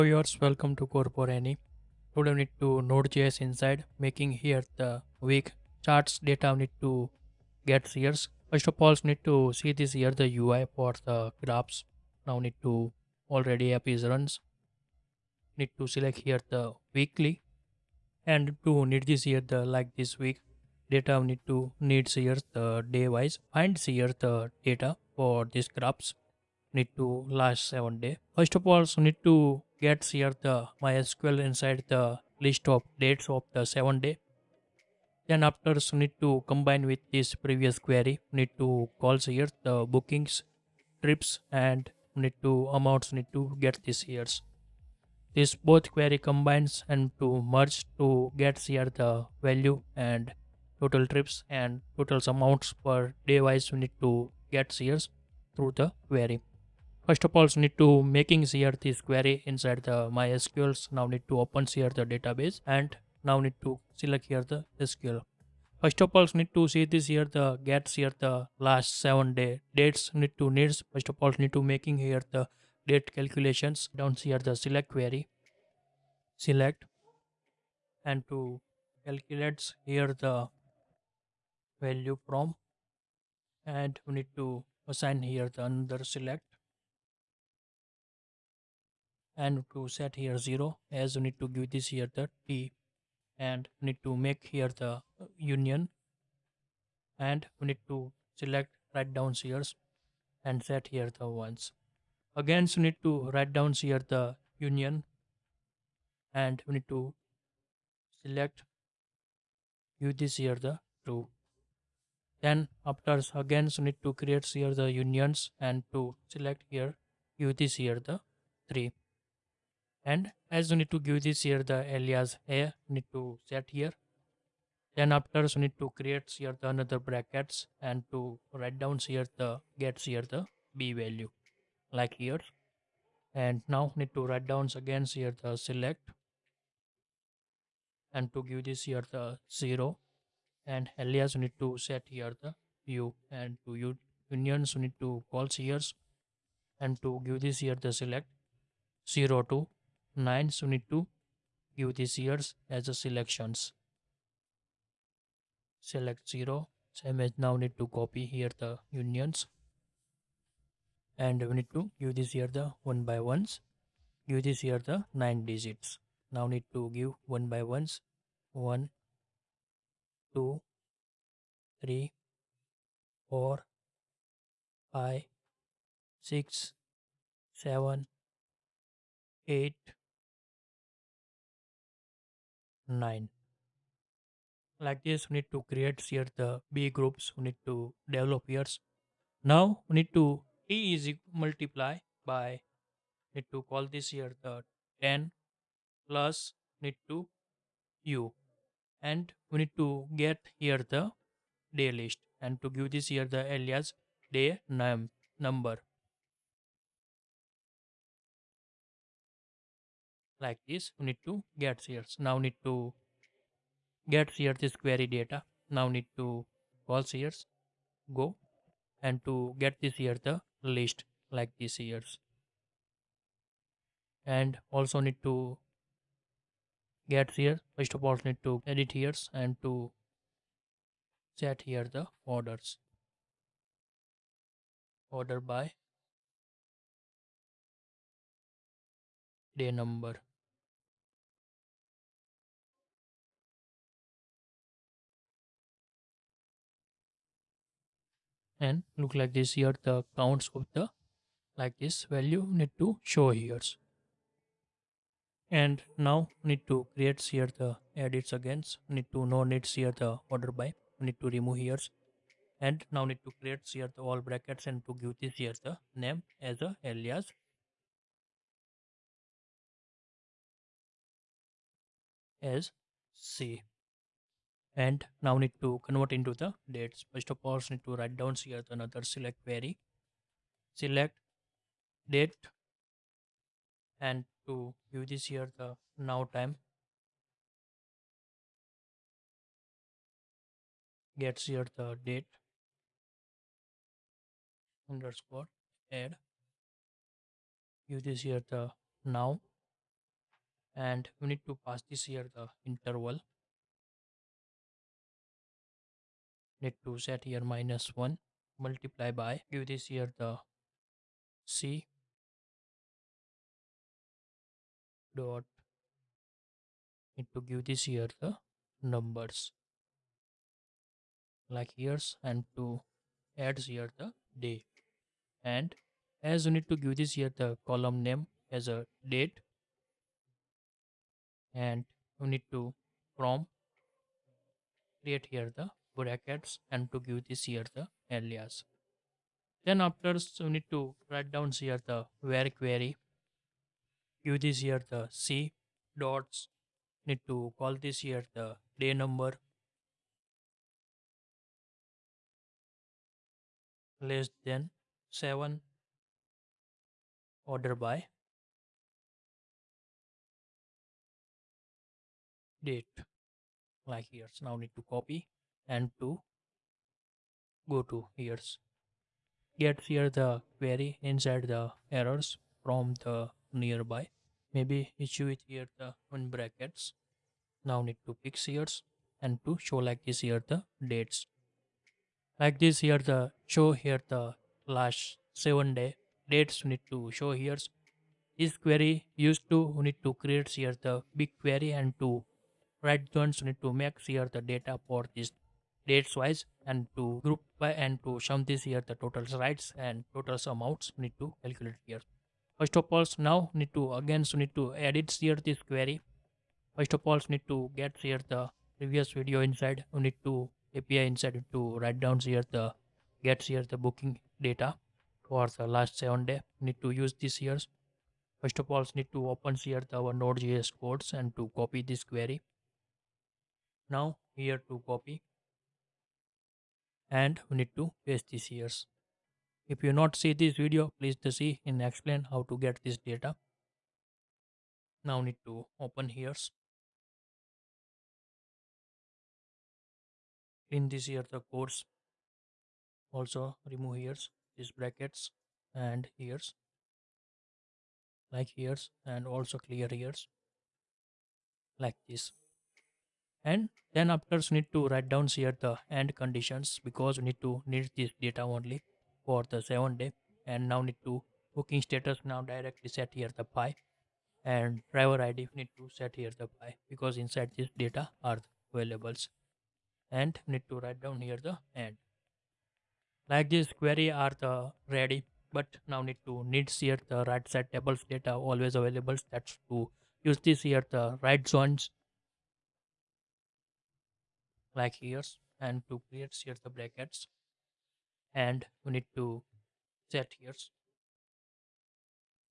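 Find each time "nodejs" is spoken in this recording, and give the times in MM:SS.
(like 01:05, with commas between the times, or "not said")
00:02, 07:00.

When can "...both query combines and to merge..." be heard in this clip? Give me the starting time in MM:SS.
00:45.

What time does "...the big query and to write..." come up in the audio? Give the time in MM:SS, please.
06:30.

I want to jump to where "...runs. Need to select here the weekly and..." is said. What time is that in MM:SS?
00:14.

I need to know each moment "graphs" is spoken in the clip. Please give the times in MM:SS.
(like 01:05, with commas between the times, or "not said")
00:11, 00:25.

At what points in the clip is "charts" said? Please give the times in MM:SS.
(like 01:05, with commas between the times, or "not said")
00:05.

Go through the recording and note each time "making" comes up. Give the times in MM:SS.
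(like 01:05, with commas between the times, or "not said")
00:03, 00:58, 01:11.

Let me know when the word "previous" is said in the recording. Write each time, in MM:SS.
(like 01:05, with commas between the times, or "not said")
00:37, 06:48.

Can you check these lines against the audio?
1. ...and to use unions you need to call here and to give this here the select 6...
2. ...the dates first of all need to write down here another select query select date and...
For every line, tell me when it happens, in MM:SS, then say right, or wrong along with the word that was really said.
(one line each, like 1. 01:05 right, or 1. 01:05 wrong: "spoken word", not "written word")
1. 02:23 wrong: "0", not "6"
2. 04:36 right.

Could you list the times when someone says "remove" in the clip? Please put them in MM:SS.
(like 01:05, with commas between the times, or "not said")
04:21, 07:23.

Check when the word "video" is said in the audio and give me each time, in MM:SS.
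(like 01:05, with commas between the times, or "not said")
06:49, 07:10.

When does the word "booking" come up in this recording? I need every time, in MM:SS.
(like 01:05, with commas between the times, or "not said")
00:39, 06:53, 07:41.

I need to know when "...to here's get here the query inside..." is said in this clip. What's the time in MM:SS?
06:07.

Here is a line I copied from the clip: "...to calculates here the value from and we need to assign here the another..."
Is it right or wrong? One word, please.
right.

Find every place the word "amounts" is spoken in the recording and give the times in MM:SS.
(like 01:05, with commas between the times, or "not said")
00:42, 00:52, 06:40.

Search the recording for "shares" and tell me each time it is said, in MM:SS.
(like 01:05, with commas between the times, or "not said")
03:31, 03:37.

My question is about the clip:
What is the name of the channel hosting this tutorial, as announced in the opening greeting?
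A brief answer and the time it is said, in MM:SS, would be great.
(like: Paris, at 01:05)
CodeForAny, at 00:00.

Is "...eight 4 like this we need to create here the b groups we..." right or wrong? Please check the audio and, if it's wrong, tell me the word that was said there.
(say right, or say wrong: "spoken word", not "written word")
wrong: "9", not "4".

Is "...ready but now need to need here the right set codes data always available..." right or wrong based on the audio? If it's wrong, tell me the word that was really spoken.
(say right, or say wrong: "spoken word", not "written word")
wrong: "tables", not "codes".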